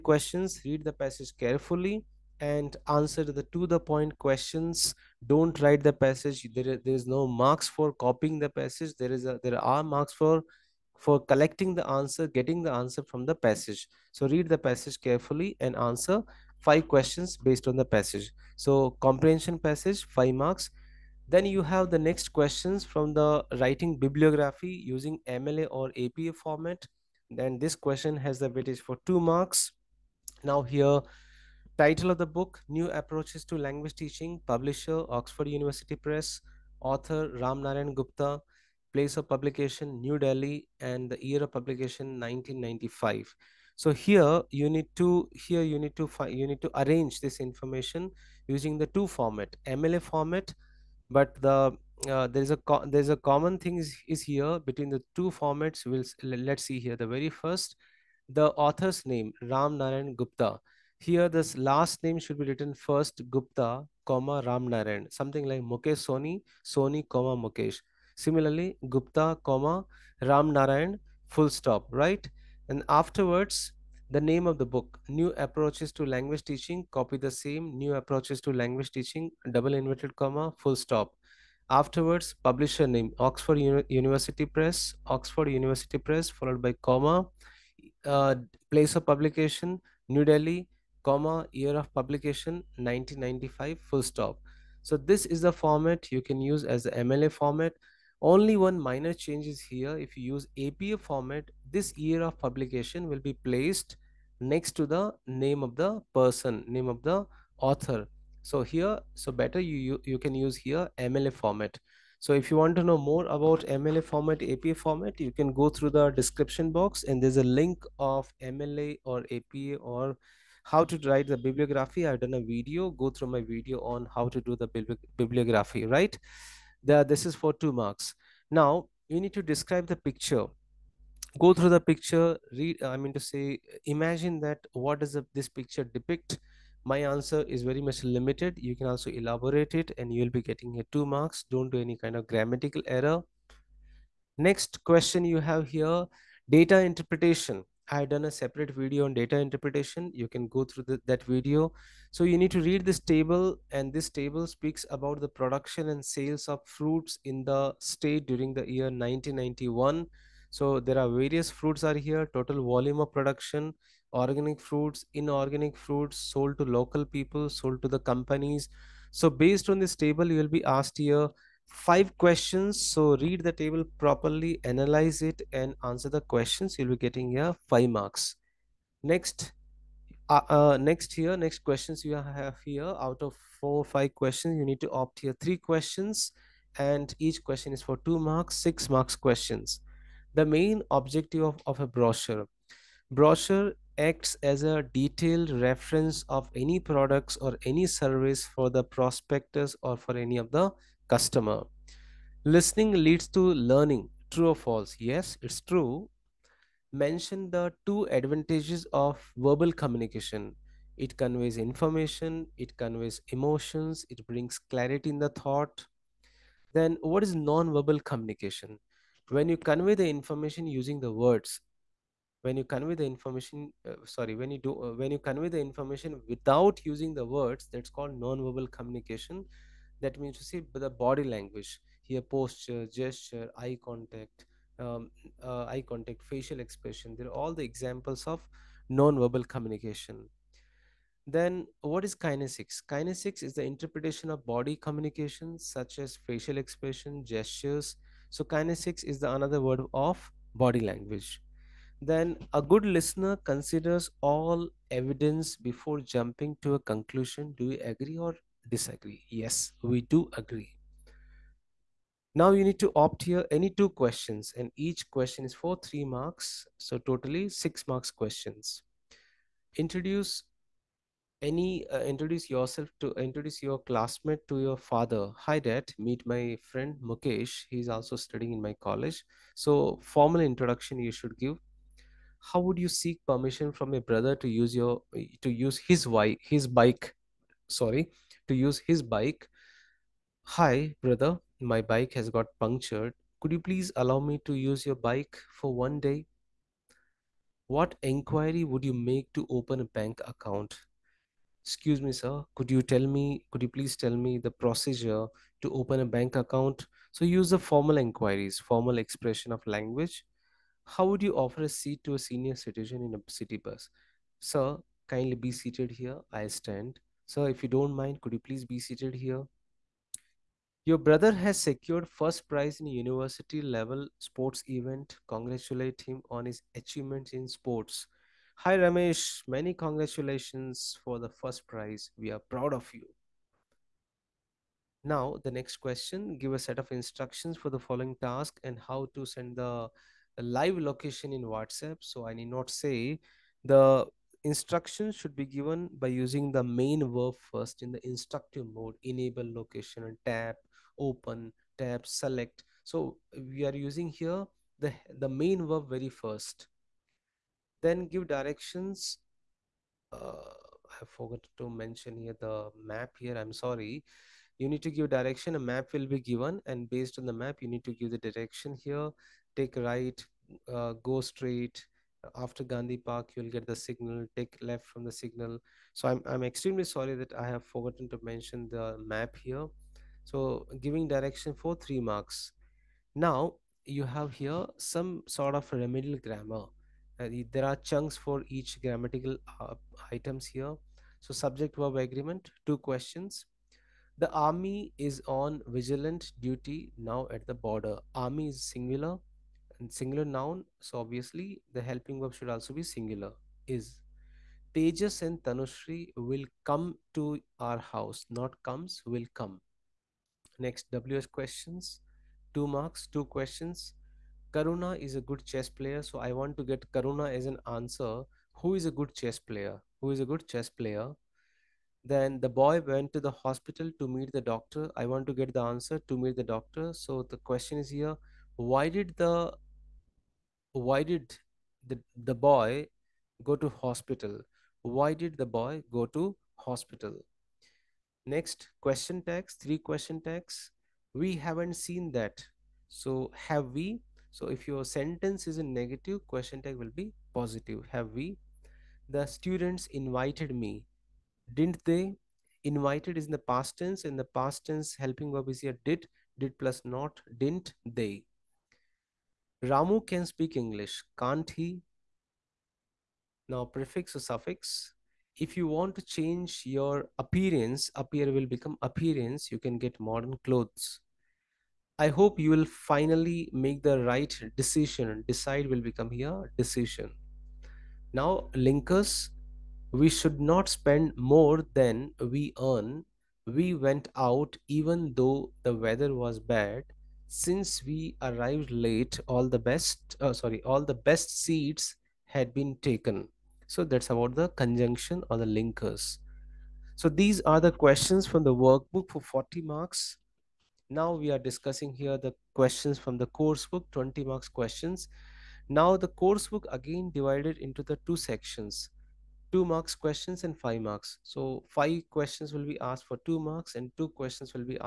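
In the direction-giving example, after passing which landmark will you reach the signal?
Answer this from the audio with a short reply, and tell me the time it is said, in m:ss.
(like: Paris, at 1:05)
Gandhi Park, at 6:12.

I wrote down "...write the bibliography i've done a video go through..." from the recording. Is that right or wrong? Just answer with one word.
right.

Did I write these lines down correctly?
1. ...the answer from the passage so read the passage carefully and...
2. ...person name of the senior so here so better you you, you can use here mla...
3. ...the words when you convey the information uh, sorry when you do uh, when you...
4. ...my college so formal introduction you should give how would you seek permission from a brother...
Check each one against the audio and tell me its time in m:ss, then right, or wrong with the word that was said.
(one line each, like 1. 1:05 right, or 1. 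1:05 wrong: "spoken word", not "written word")
1. 0:12 right
2. 1:46 wrong: "author", not "senior"
3. 3:41 right
4. 4:38 right.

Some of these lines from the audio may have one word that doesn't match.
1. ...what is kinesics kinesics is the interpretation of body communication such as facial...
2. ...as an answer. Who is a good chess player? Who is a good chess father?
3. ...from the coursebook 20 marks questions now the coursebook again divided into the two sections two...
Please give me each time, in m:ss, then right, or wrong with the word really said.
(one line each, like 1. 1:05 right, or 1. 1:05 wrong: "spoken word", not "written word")
1. 4:01 right
2. 6:57 wrong: "player", not "father"
3. 8:22 right.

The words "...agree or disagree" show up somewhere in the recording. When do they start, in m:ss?
4:17.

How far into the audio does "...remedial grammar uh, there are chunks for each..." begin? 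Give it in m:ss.
6:25.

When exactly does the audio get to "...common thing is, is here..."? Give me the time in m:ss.
0:53.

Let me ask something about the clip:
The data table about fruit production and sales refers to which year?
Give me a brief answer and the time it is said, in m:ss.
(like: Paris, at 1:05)
1991, at 2:39.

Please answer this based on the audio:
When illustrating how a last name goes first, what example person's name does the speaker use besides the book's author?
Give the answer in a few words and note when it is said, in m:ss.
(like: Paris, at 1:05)
Mukesh Soni, at 1:05.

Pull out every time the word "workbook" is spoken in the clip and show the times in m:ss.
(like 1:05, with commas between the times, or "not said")
8:18.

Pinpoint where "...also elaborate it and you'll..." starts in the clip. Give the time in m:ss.
2:18.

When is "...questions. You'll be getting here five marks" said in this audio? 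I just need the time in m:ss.
2:56.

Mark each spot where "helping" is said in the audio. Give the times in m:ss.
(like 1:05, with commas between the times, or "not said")
6:41, 7:34.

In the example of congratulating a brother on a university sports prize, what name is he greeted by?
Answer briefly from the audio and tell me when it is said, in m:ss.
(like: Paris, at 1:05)
Ramesh, at 5:28.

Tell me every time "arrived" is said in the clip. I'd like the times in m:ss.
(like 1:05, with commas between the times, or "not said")
8:08.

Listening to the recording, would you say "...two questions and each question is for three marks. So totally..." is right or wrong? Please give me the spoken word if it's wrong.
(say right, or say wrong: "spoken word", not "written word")
right.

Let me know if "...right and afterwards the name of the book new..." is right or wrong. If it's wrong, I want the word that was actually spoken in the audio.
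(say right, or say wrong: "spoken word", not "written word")
right.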